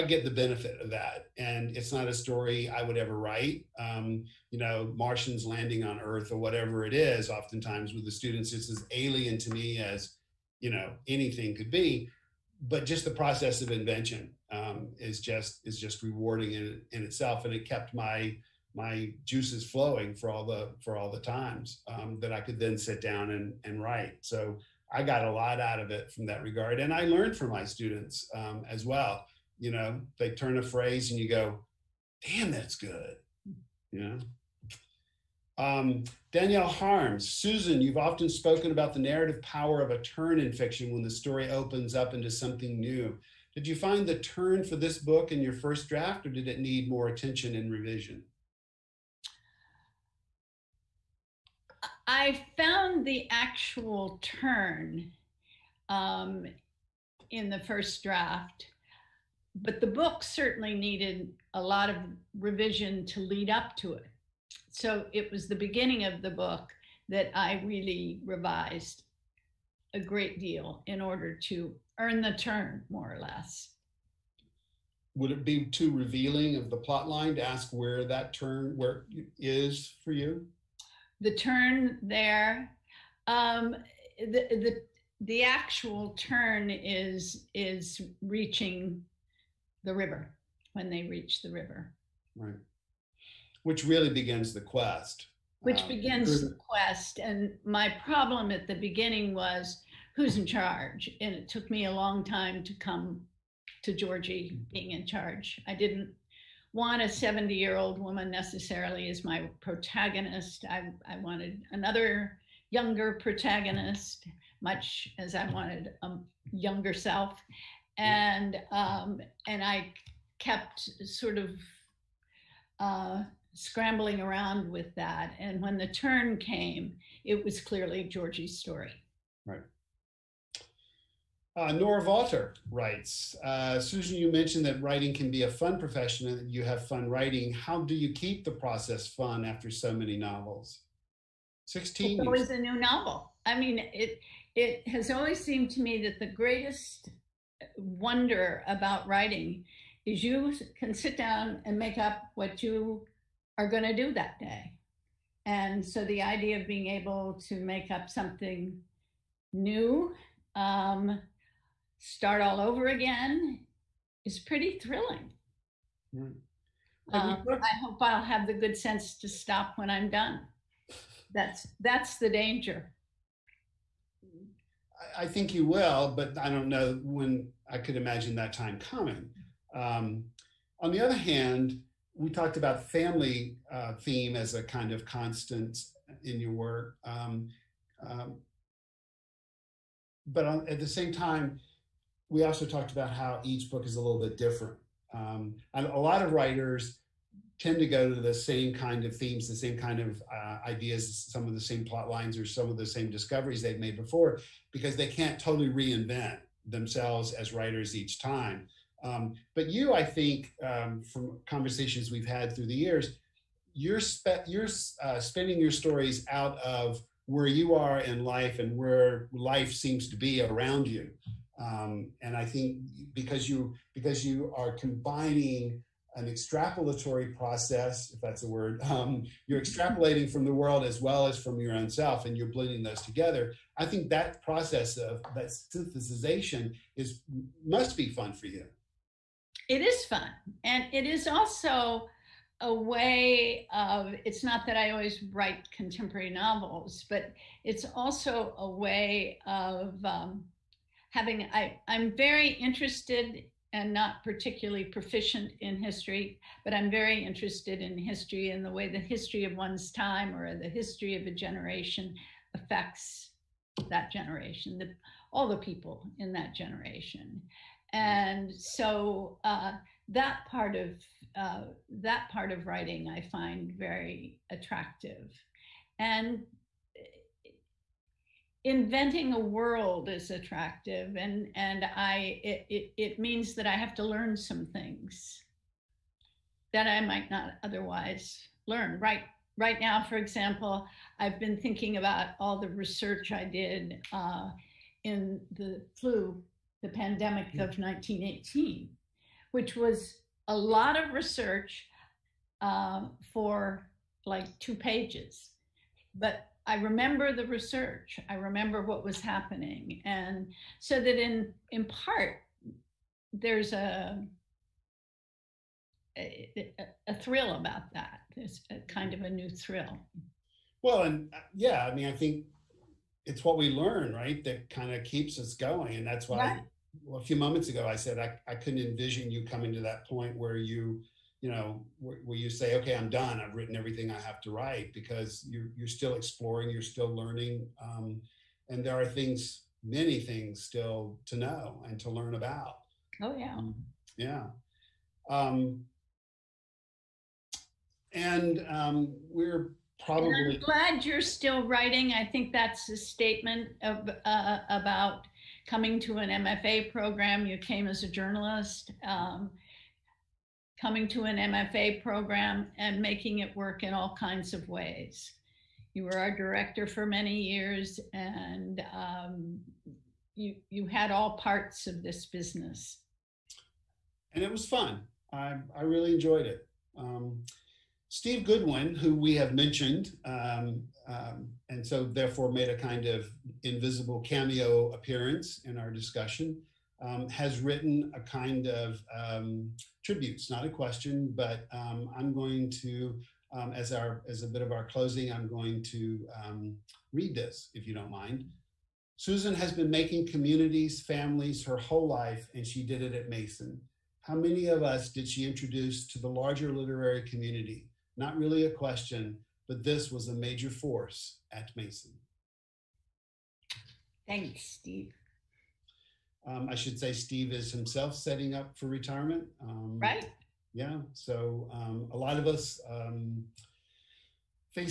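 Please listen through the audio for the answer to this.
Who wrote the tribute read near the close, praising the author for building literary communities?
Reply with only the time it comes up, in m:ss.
6:18.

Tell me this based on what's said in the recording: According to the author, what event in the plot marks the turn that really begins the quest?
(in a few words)
Reaching the river.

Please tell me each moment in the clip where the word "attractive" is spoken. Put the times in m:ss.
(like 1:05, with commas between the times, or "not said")
4:34, 4:40.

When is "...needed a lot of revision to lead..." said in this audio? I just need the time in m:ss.
1:00.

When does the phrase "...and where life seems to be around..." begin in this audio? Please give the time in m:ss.
3:38.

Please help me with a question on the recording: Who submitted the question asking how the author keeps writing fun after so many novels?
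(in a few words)
Nora Walter.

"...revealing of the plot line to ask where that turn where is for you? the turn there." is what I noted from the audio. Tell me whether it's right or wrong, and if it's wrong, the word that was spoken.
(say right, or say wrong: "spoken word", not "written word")
right.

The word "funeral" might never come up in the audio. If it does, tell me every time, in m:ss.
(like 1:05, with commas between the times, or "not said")
not said.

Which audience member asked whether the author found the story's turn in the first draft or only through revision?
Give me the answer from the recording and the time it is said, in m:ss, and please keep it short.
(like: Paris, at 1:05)
Danielle Harms, at 0:36.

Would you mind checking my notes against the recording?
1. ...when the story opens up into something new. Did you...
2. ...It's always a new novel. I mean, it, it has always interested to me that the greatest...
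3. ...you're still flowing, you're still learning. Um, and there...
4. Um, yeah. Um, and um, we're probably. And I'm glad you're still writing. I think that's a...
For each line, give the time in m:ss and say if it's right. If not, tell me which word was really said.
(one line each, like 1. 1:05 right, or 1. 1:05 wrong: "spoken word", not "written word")
1. 0:40 right
2. 2:22 wrong: "seemed", not "interested"
3. 5:35 wrong: "exploring", not "flowing"
4. 5:43 right.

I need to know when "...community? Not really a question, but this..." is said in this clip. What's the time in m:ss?
6:47.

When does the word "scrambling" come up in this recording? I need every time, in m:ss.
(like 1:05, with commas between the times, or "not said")
2:03.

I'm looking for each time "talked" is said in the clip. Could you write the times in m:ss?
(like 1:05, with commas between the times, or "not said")
3:02, 3:12.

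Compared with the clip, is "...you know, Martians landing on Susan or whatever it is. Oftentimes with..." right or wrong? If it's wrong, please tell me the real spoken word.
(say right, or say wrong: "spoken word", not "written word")
wrong: "Earth", not "Susan".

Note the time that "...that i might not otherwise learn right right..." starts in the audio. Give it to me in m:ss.
4:46.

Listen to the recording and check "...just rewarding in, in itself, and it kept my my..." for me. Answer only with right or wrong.
right.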